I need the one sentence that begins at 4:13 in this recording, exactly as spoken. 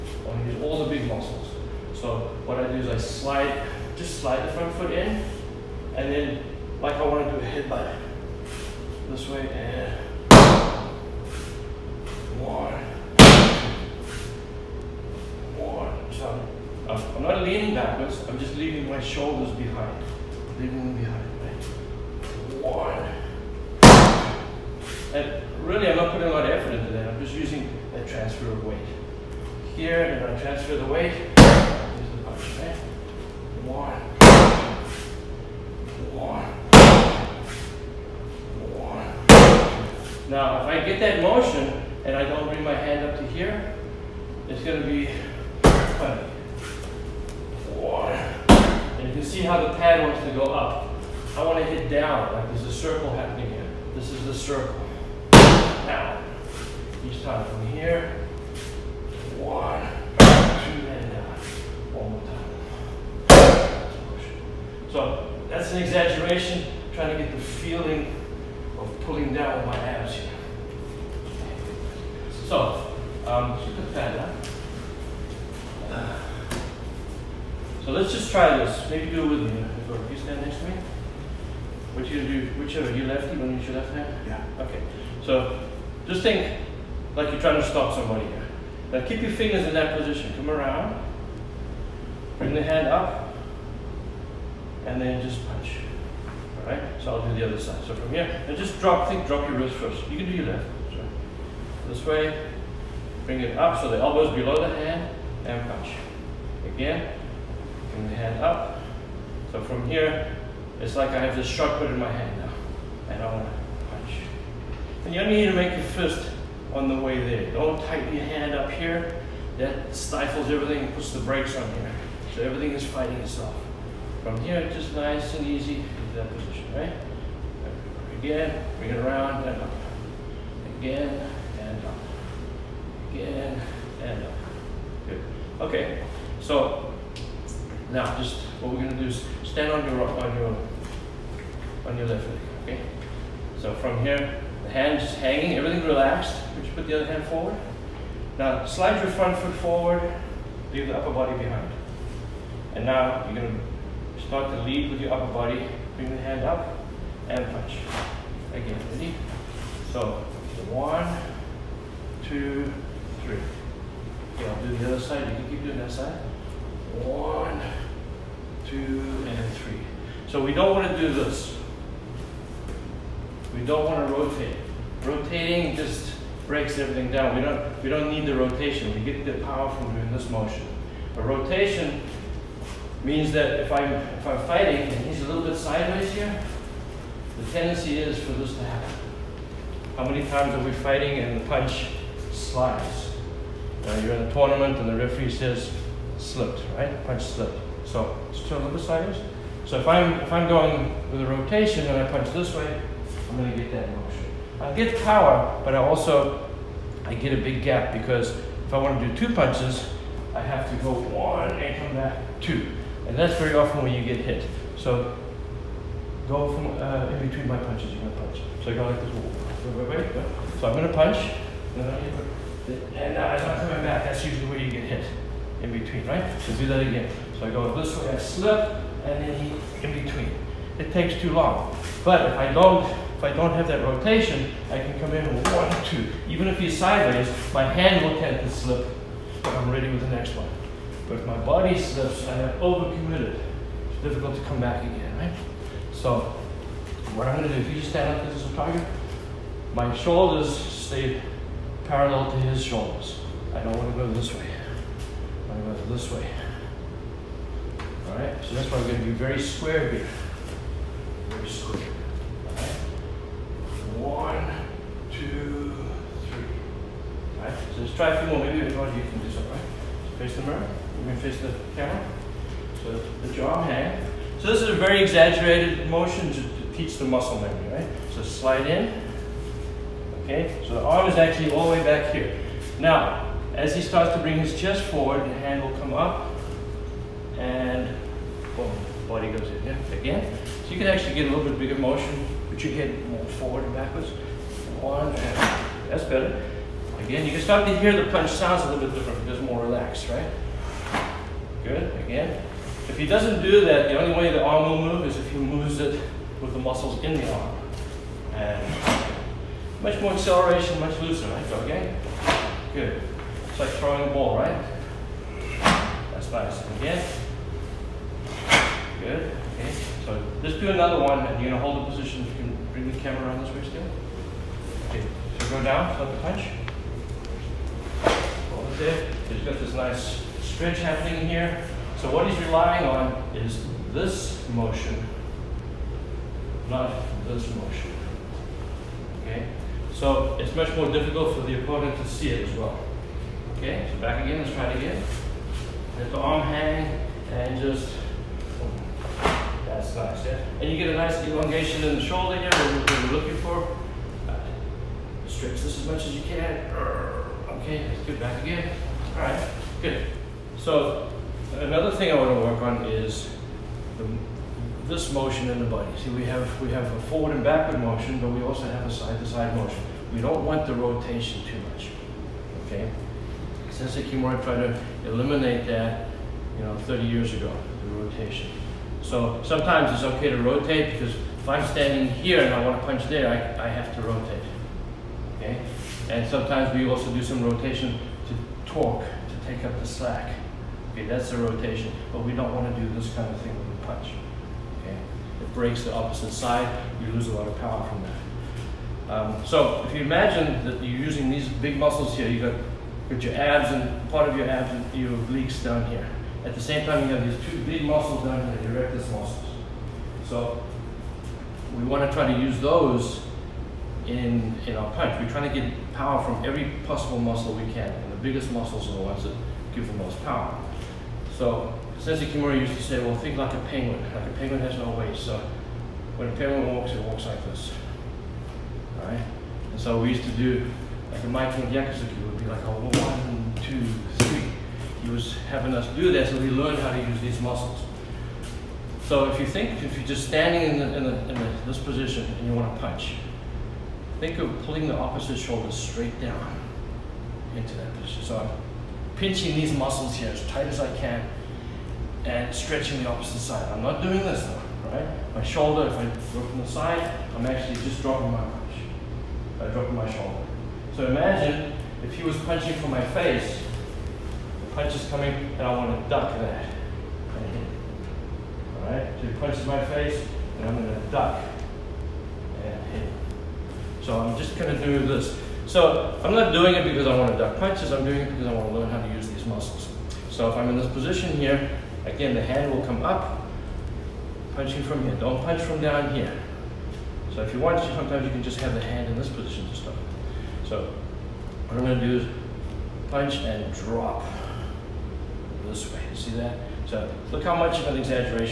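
I don't wanna go this way.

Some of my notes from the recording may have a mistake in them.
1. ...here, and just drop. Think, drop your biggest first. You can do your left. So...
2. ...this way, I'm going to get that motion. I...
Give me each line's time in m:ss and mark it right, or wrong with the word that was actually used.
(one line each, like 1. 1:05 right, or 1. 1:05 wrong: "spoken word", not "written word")
1. 1:38 wrong: "wrist", not "biggest"
2. 3:22 right.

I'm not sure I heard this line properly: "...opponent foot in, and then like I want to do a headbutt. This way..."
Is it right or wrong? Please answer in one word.
wrong.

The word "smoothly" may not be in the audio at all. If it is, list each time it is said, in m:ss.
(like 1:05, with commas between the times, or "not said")
not said.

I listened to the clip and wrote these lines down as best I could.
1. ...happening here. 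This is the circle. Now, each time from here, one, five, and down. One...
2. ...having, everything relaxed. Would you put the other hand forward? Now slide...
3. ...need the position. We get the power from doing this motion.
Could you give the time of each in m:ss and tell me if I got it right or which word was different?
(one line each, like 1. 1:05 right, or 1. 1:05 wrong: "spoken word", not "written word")
1. 0:53 wrong: "two", not "five"
2. 2:25 wrong: "hanging", not "having"
3. 2:58 wrong: "rotation", not "position".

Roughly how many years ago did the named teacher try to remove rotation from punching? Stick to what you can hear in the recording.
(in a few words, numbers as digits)
30.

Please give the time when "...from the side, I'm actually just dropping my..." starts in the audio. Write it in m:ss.
7:36.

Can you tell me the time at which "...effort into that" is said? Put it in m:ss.
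0:26.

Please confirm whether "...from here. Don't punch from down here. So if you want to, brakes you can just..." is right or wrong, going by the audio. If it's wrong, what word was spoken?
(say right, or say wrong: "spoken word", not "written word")
wrong: "sometimes", not "brakes".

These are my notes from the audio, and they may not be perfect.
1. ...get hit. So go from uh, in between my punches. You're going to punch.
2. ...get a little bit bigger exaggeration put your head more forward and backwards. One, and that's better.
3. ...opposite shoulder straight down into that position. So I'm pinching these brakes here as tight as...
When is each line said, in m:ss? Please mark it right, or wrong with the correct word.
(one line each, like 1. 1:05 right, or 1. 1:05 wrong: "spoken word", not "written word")
1. 3:34 right
2. 4:51 wrong: "motion", not "exaggeration"
3. 7:24 wrong: "muscles", not "brakes".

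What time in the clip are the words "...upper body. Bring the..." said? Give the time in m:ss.
2:35.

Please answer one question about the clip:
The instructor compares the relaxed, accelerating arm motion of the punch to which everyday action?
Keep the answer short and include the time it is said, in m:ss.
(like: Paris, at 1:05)
Throwing a ball, at 5:13.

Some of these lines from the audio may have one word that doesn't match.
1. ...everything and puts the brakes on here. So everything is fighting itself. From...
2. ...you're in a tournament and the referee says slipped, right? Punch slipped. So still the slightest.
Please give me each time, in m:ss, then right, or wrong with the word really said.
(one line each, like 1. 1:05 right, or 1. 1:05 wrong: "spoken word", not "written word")
1. 2:00 right
2. 3:13 right.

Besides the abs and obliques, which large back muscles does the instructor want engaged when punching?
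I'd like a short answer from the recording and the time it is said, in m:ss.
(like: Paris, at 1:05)
Erector muscles, at 6:48.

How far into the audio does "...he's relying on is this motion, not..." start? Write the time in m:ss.
5:32.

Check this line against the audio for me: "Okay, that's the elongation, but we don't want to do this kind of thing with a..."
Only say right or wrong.
wrong.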